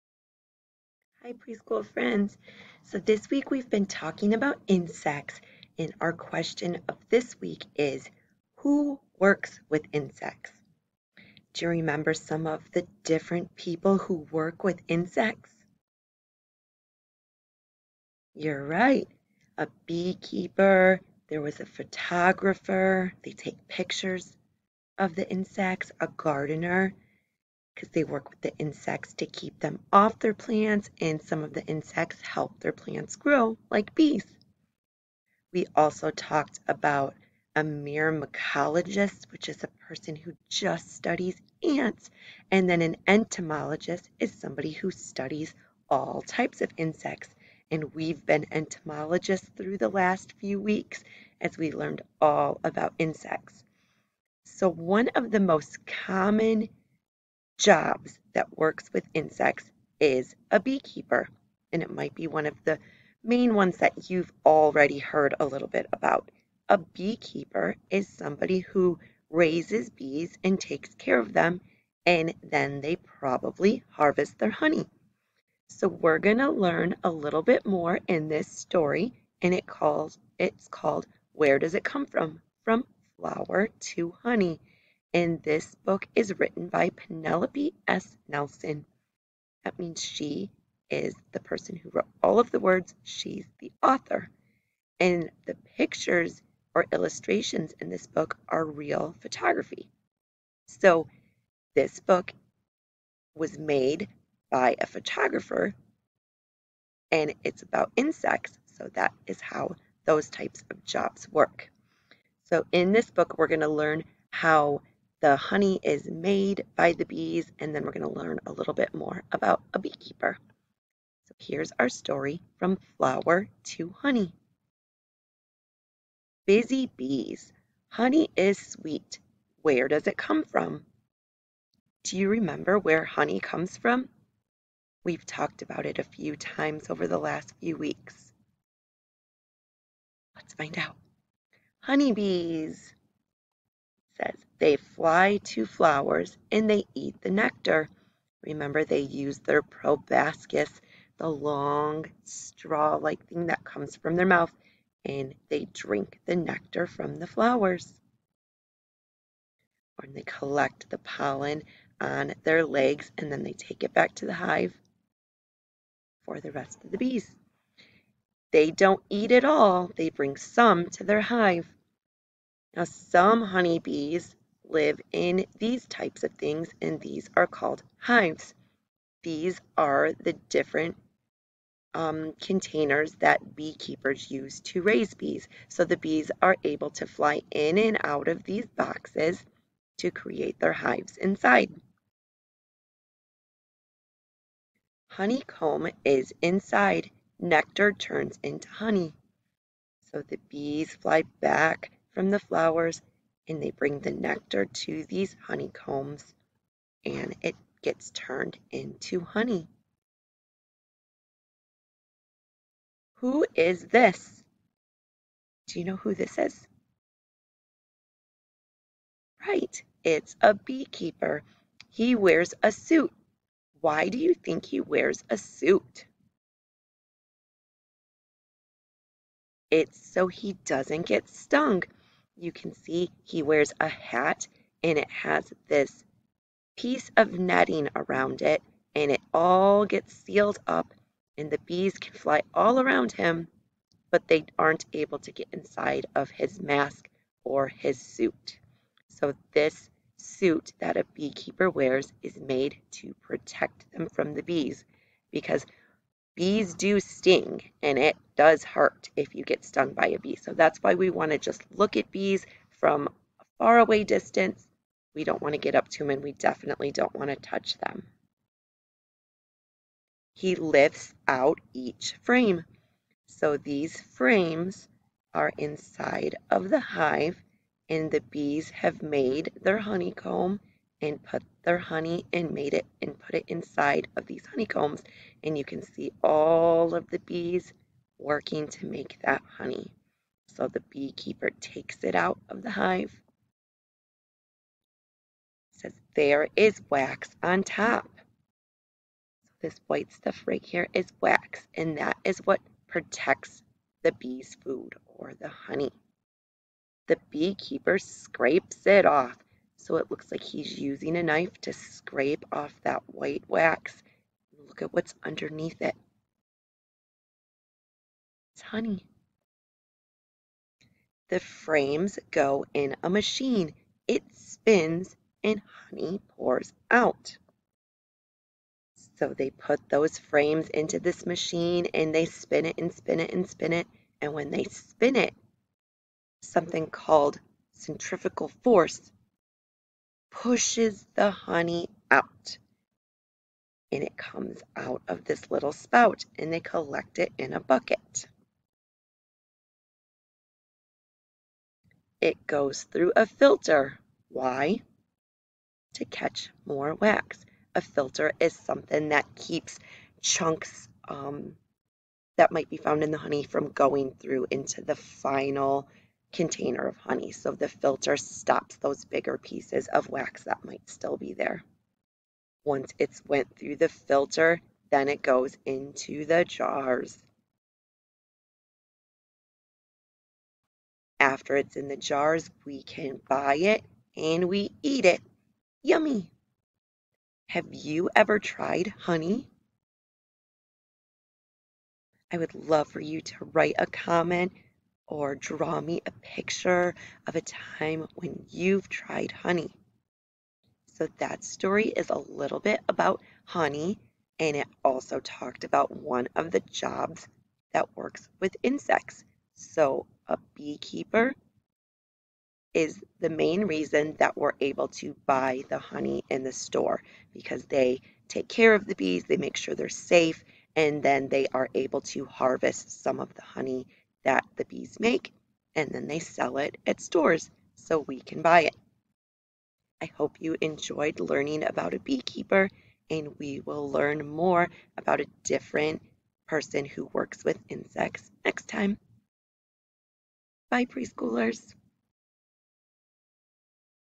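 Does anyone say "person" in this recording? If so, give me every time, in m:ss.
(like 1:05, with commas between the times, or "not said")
0:39, 1:31, 7:16.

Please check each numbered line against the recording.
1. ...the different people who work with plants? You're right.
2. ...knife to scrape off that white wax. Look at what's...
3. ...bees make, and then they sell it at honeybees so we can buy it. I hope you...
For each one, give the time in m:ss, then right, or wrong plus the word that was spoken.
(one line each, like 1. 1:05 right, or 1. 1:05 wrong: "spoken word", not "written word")
1. 0:12 wrong: "insects", not "plants"
2. 5:11 right
3. 7:04 wrong: "stores", not "honeybees".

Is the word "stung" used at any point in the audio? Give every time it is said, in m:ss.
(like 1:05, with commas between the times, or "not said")
3:51, 4:19.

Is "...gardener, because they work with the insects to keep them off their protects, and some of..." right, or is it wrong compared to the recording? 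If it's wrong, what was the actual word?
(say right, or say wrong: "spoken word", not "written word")
wrong: "plants", not "protects".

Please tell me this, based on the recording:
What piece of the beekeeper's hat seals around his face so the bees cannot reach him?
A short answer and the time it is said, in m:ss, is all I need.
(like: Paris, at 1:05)
netting, at 3:57.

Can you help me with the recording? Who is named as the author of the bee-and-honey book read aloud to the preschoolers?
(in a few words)
Penelope S. Nelson.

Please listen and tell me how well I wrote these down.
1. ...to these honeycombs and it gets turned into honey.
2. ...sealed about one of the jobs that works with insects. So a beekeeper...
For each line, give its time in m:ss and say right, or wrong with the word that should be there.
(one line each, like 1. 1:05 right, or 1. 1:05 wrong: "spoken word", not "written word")
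1. 3:24 right
2. 6:45 wrong: "talked", not "sealed".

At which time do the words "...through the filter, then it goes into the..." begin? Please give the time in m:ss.
6:13.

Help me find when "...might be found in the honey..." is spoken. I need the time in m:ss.
6:02.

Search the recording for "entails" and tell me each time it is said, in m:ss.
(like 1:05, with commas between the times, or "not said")
not said.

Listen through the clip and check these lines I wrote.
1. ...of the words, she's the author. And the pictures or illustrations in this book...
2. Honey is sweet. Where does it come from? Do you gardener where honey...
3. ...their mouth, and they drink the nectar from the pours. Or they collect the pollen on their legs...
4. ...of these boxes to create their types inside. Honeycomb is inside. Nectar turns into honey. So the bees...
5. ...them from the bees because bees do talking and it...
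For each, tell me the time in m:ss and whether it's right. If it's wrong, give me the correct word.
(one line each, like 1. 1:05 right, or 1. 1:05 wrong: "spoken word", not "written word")
1. 1:32 right
2. 2:07 wrong: "remember", not "gardener"
3. 2:34 wrong: "flowers", not "pours"
4. 3:08 wrong: "hives", not "types"
5. 4:13 wrong: "sting", not "talking".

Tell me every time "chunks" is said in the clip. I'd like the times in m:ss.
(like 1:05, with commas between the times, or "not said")
6:00.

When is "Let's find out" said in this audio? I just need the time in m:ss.
2:20.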